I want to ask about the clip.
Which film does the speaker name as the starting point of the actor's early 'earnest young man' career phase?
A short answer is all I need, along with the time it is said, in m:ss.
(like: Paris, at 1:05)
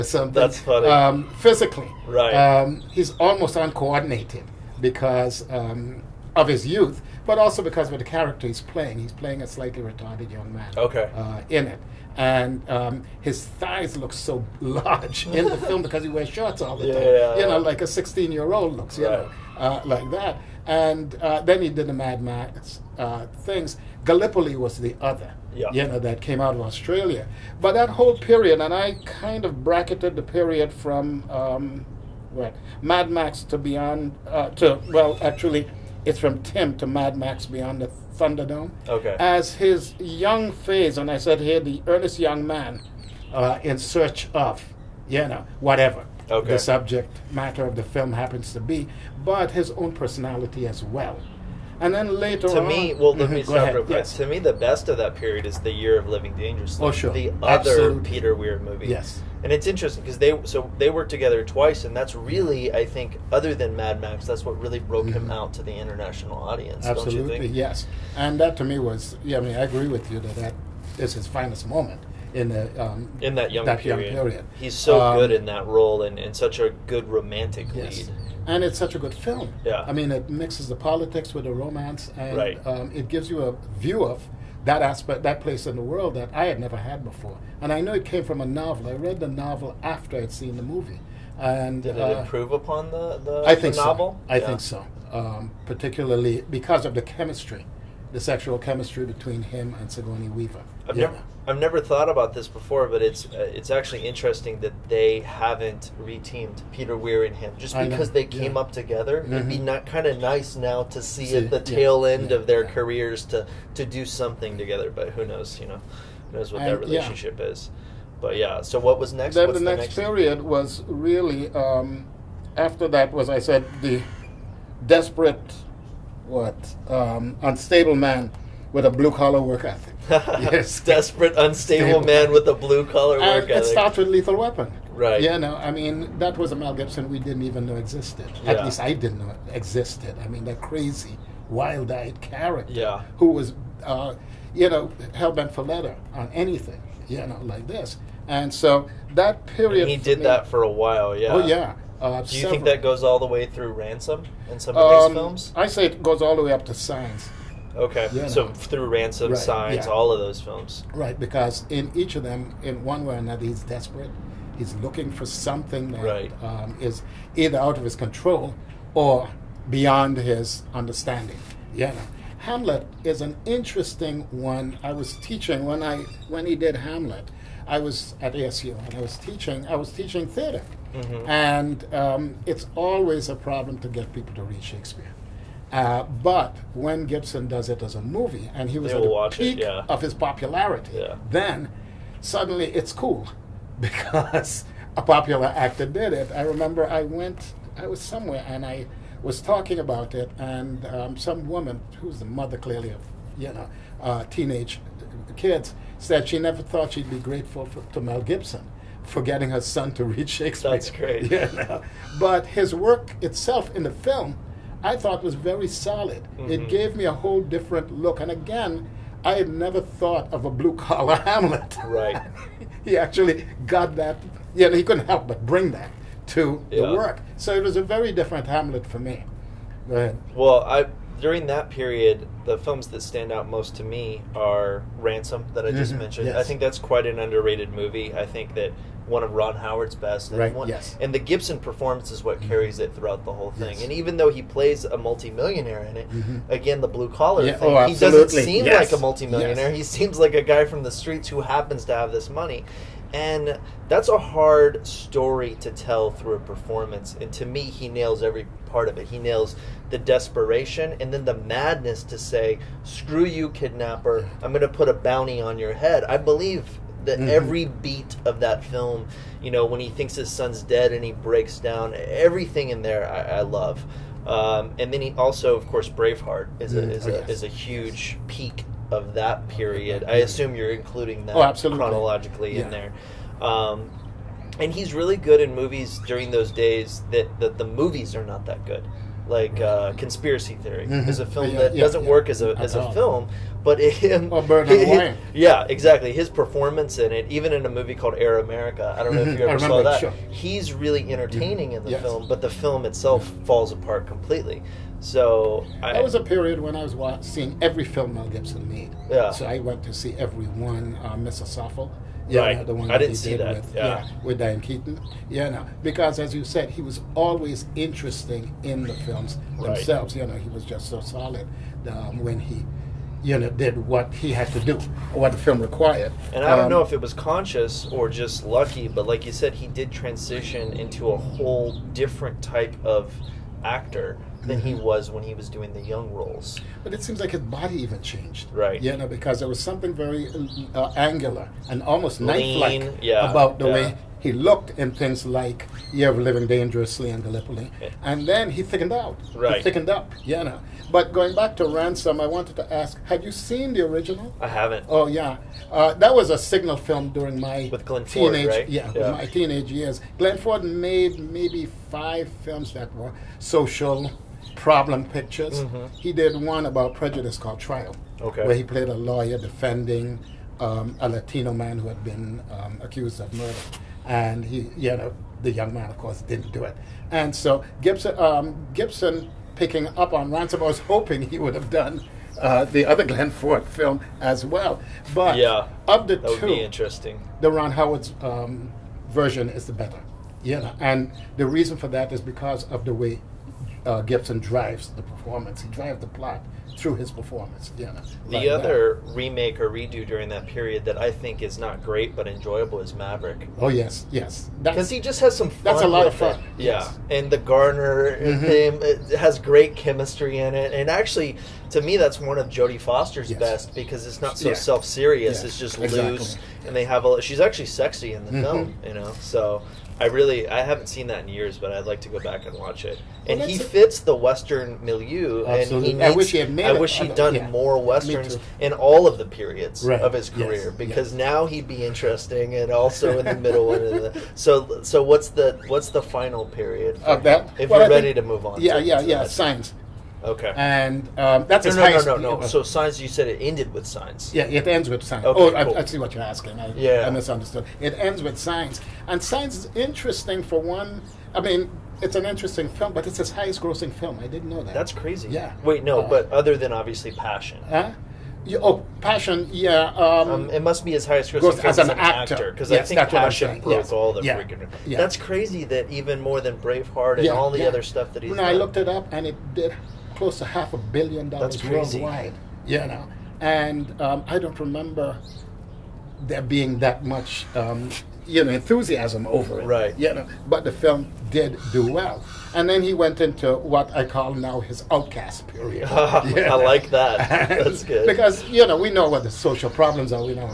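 Tim, at 0:36.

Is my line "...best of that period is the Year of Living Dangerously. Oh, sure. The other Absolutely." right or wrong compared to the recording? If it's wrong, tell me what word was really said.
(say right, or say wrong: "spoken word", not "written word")
right.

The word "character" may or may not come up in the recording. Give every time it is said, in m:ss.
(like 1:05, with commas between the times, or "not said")
0:08, 2:22.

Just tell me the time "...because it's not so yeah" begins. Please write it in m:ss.
6:53.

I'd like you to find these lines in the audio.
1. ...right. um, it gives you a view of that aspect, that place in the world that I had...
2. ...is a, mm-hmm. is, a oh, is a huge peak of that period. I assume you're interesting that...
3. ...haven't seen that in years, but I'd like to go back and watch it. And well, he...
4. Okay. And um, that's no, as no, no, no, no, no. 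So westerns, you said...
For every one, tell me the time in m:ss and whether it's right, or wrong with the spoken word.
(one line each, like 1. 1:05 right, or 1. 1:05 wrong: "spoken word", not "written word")
1. 1:22 right
2. 4:36 wrong: "including", not "interesting"
3. 7:00 right
4. 7:20 wrong: "signs", not "westerns".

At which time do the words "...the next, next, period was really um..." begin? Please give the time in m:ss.
1:59.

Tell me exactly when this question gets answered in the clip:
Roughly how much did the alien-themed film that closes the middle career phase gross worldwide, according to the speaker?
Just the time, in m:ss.
7:50.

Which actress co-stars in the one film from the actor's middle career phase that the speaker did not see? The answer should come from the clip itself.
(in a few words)
Diane Keaton.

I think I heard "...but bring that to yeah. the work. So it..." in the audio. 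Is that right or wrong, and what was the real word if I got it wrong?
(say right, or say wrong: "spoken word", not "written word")
right.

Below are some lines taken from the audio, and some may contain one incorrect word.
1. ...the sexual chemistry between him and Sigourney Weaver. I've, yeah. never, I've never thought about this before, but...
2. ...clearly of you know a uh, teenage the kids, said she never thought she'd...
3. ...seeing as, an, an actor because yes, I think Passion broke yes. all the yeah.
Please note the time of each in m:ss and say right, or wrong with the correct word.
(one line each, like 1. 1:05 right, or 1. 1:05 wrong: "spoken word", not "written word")
1. 1:38 right
2. 3:22 right
3. 7:41 wrong: "grossing", not "seeing".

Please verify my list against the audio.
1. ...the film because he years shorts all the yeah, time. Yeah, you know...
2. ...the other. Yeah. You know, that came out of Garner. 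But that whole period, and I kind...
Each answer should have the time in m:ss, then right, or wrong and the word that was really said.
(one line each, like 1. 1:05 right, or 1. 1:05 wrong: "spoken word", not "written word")
1. 0:15 wrong: "wears", not "years"
2. 0:24 wrong: "Australia", not "Garner".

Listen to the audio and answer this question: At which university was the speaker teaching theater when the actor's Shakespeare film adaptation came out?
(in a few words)
ASU.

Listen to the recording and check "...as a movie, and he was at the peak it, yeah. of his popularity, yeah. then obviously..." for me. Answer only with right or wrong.
wrong.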